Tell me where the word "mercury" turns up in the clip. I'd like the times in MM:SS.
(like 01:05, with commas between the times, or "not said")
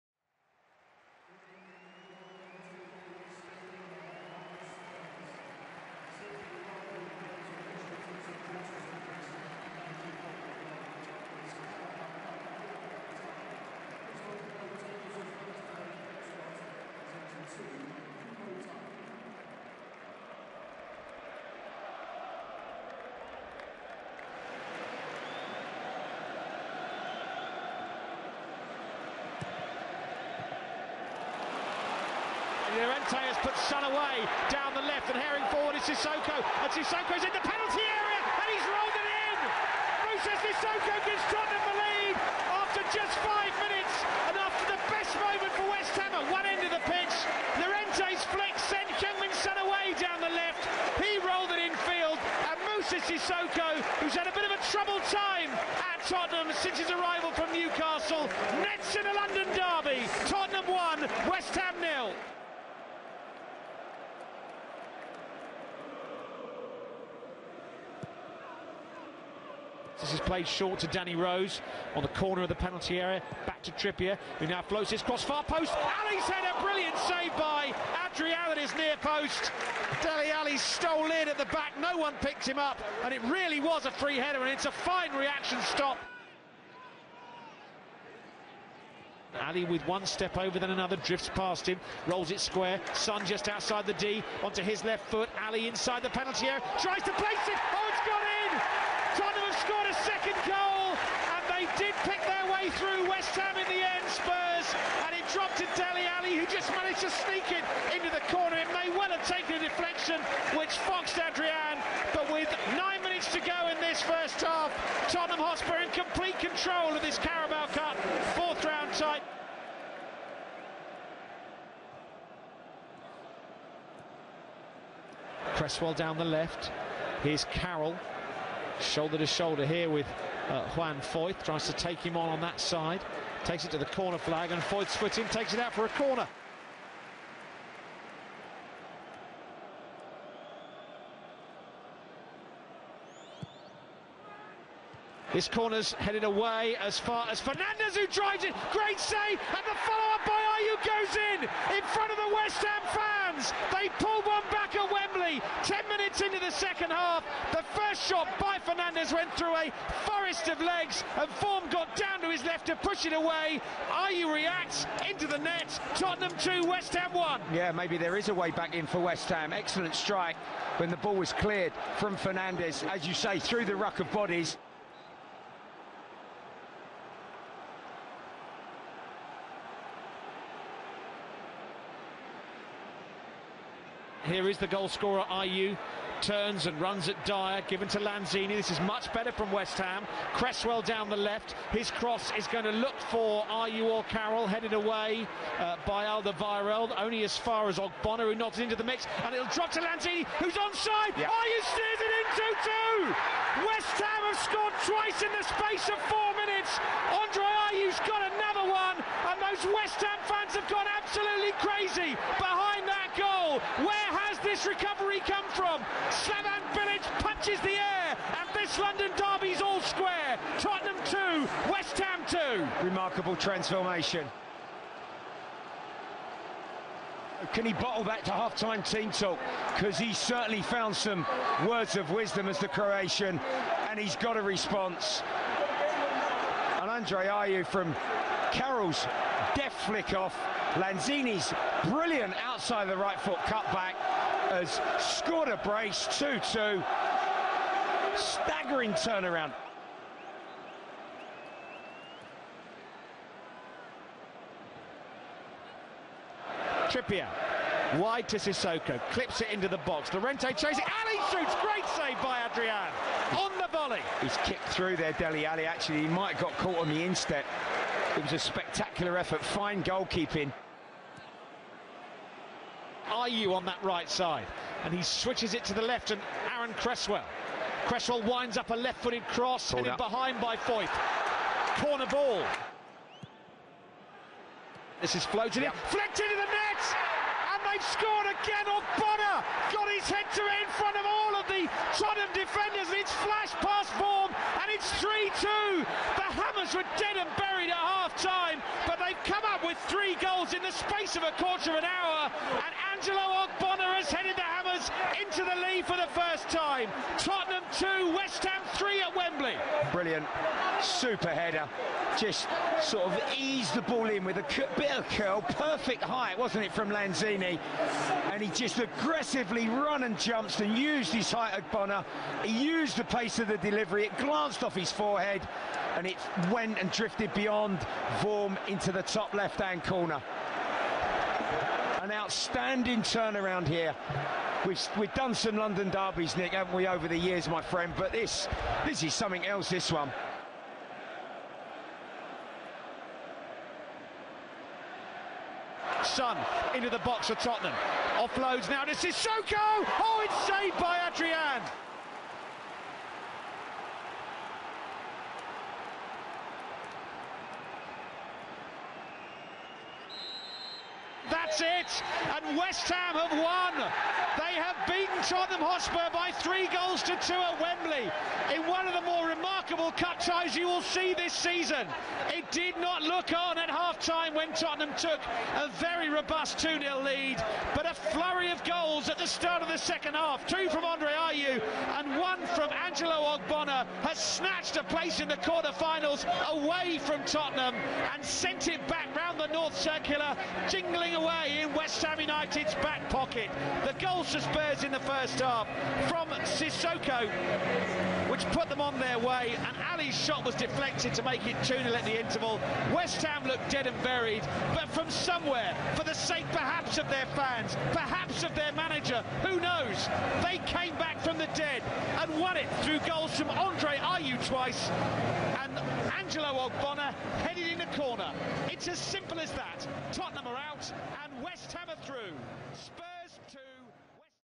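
not said.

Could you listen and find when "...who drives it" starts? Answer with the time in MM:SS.
02:27.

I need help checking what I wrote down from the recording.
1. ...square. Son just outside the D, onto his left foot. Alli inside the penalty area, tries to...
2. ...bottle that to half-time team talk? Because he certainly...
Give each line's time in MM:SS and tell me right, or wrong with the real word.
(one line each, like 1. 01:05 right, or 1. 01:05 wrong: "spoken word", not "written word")
1. 01:32 right
2. 03:47 right.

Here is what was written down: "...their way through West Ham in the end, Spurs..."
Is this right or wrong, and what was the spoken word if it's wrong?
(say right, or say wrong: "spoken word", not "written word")
right.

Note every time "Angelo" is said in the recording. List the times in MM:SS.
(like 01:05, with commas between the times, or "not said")
05:02, 06:22, 06:56.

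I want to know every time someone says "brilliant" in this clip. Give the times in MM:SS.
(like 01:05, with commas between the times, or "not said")
01:16, 04:01, 05:09.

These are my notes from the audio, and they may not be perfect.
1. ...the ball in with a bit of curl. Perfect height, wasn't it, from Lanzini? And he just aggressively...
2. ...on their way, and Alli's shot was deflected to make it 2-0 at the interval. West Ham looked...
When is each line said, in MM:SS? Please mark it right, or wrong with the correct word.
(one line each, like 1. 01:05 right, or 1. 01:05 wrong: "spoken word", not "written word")
1. 05:13 right
2. 06:38 right.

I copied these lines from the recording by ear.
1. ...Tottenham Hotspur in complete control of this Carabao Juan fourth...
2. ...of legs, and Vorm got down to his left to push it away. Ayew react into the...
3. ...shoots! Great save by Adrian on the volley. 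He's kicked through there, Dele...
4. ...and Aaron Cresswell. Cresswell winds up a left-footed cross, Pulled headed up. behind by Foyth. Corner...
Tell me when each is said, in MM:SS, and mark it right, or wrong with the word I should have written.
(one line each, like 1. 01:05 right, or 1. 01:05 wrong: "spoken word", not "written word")
1. 01:55 wrong: "Cup", not "Juan"
2. 02:40 right
3. 04:21 right
4. 04:36 right.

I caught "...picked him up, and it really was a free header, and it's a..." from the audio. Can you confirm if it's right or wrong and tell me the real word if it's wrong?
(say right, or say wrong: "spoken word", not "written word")
right.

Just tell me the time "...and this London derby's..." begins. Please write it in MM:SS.
03:38.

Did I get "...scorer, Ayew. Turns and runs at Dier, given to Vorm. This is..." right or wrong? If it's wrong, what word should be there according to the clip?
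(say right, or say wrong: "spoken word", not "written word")
wrong: "Lanzini", not "Vorm".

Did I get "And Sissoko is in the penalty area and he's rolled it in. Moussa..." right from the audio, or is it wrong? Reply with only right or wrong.
right.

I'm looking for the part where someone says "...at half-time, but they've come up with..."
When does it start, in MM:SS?
04:57.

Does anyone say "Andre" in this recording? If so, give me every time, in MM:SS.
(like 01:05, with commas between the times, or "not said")
03:27, 03:56, 06:20, 06:53.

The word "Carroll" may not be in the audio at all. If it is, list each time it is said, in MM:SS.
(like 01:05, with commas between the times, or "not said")
02:07, 03:14, 03:58.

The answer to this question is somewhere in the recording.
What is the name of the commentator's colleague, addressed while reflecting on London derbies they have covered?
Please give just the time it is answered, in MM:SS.
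05:36.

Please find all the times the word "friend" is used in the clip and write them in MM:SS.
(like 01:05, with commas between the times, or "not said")
05:37.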